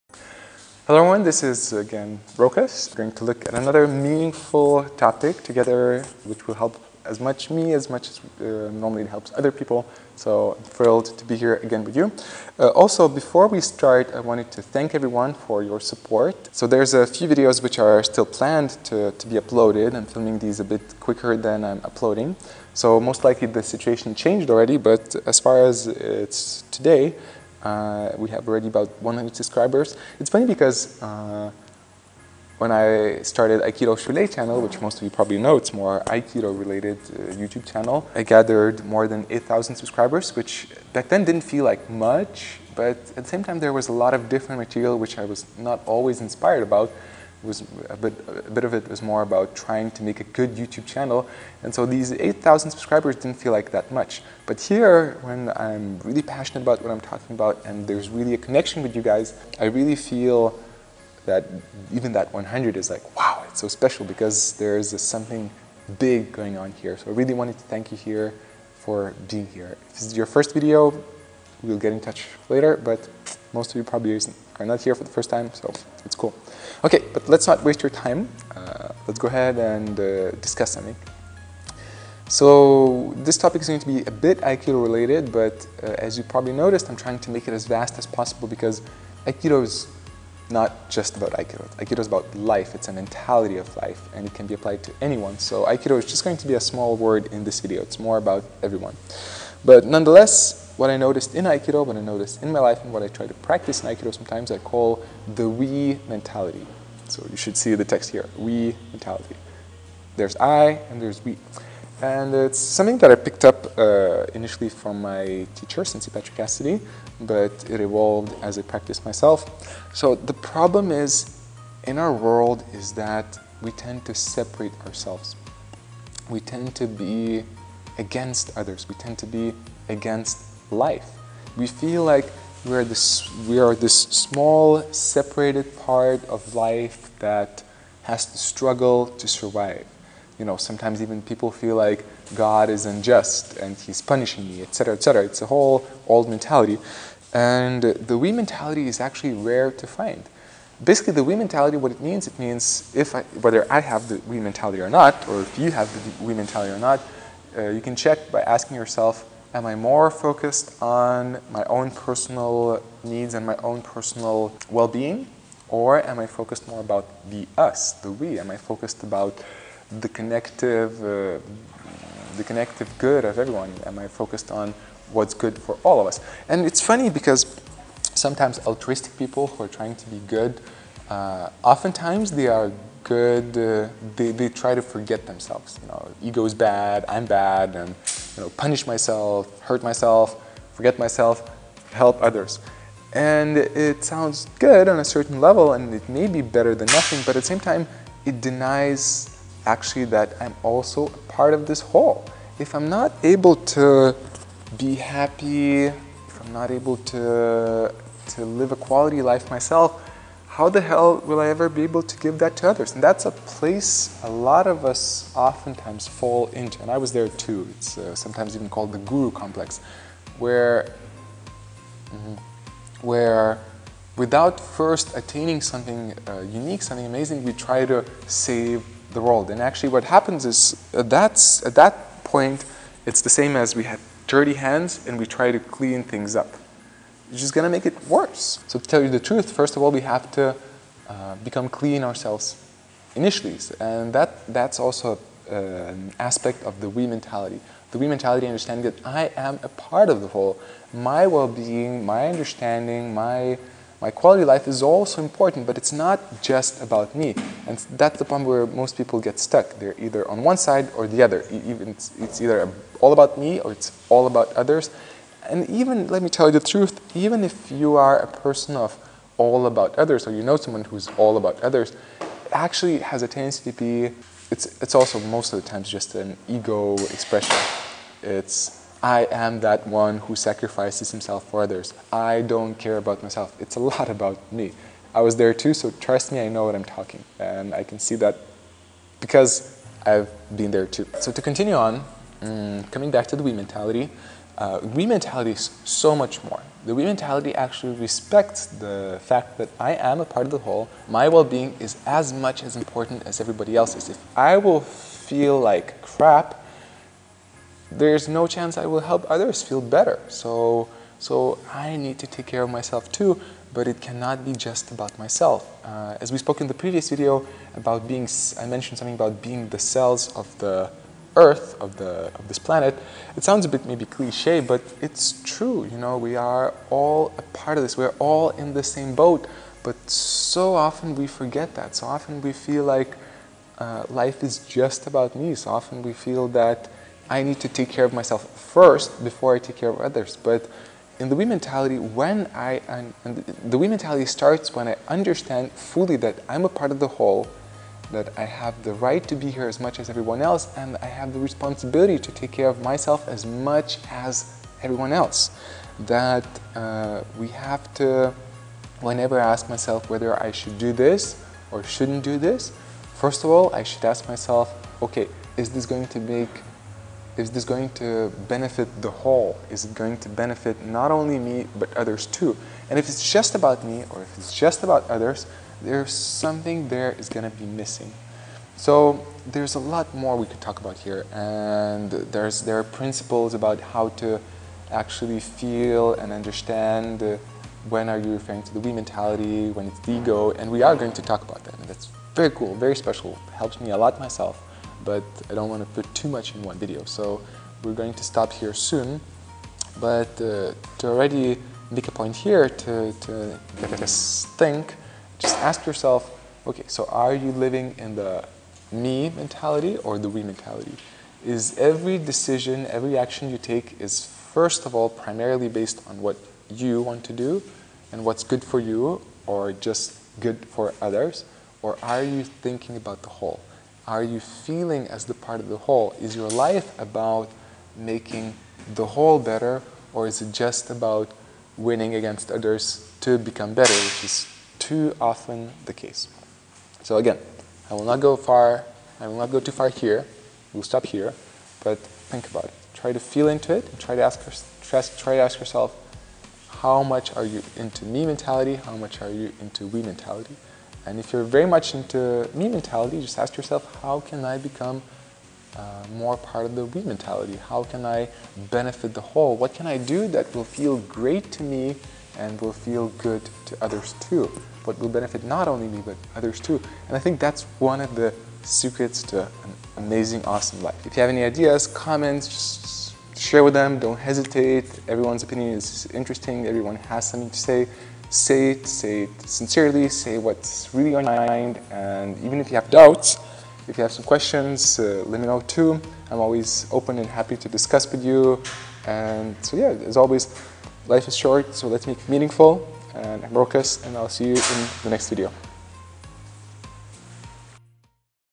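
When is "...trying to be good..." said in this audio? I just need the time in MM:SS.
02:59.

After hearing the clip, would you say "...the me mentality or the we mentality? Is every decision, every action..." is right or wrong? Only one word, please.
right.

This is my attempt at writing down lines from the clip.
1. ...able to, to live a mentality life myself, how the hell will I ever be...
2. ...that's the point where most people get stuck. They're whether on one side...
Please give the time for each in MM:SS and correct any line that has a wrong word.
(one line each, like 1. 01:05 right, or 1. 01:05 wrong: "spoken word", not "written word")
1. 03:26 wrong: "quality", not "mentality"
2. 04:17 wrong: "either", not "whether".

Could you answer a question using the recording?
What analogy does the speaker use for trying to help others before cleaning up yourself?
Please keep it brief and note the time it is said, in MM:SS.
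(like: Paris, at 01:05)
dirty hands, at 03:54.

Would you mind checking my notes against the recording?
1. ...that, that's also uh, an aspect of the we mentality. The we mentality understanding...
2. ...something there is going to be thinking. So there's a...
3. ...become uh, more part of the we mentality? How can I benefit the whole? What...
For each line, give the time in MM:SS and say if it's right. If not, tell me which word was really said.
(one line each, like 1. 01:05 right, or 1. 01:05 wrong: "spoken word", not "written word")
1. 04:04 right
2. 06:16 wrong: "missing", not "thinking"
3. 07:34 right.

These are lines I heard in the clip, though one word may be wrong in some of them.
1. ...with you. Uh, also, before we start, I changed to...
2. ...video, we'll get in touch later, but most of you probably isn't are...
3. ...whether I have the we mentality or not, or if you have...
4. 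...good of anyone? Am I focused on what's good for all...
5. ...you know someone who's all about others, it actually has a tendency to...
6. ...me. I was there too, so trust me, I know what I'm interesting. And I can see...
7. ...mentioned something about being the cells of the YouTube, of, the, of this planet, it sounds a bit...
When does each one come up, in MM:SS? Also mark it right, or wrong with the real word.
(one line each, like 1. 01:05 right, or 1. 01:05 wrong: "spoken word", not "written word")
1. 00:11 wrong: "wanted", not "changed"
2. 01:10 right
3. 02:33 right
4. 02:52 wrong: "everyone", not "anyone"
5. 04:30 right
6. 04:44 wrong: "talking", not "interesting"
7. 05:18 wrong: "Earth", not "YouTube".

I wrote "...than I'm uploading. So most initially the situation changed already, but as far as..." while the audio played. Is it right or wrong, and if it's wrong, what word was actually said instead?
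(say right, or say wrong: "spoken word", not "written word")
wrong: "likely", not "initially".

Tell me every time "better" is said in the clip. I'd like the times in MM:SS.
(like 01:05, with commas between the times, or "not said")
03:16, 05:09, 07:09, 07:13.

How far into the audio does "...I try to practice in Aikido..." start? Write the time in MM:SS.
01:43.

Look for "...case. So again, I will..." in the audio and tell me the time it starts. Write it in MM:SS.
07:15.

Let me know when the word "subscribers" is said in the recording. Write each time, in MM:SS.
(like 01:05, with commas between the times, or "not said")
00:29, 00:39, 00:52.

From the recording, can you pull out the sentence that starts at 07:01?
Or are you thinking about the whole?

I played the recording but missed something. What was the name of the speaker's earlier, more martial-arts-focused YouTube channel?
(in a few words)
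Aikido Shule.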